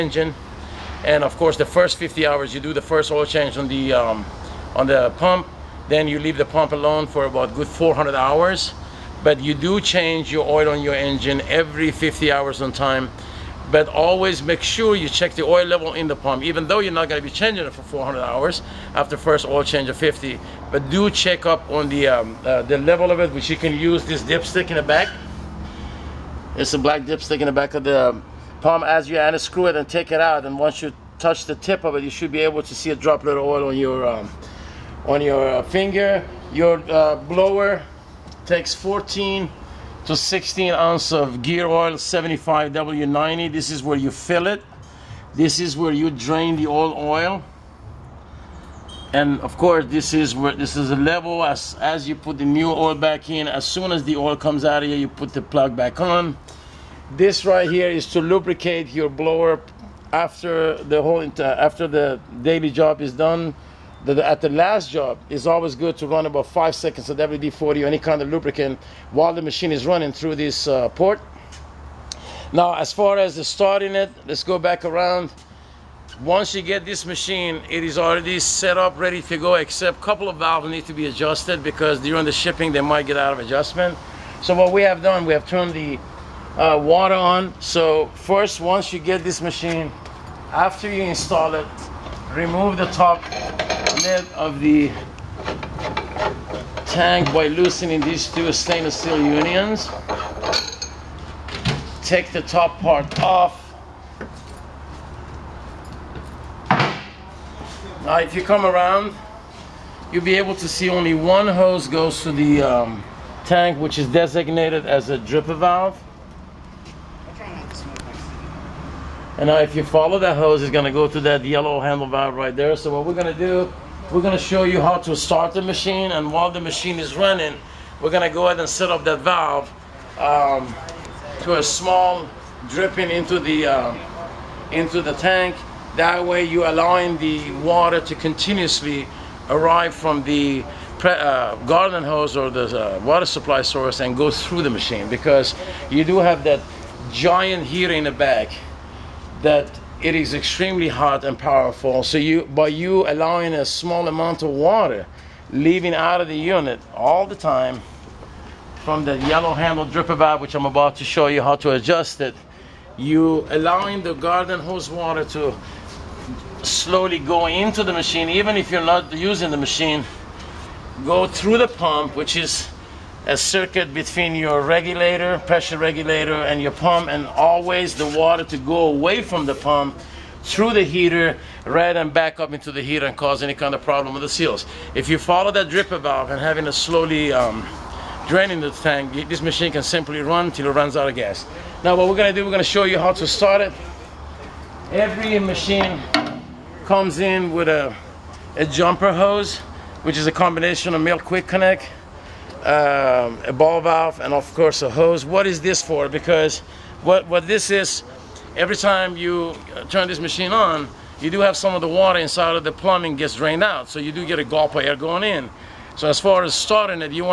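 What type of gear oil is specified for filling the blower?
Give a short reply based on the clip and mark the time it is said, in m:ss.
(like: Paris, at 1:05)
75W90, at 0:41.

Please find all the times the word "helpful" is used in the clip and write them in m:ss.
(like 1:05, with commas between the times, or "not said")
not said.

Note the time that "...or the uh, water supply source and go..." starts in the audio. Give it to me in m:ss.
2:22.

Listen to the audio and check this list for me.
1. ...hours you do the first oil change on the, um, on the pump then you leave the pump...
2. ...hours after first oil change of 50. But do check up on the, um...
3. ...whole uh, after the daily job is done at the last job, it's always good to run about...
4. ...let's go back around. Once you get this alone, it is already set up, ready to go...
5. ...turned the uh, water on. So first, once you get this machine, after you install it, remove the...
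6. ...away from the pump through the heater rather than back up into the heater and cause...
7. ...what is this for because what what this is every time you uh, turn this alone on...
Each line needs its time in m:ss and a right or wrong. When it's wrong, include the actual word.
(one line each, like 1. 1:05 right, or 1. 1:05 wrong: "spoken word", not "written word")
1. 0:02 right
2. 0:18 right
3. 1:01 right
4. 1:14 wrong: "machine", not "alone"
5. 1:25 right
6. 2:58 right
7. 3:25 wrong: "machine", not "alone".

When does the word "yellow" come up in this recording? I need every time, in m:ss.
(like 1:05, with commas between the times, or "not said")
2:01, 2:39.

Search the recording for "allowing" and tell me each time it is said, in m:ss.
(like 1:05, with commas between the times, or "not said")
2:16, 2:33, 2:43.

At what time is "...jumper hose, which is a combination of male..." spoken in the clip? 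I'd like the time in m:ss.
3:18.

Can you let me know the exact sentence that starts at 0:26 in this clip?
It's a black dipstick in the back of the um, pump.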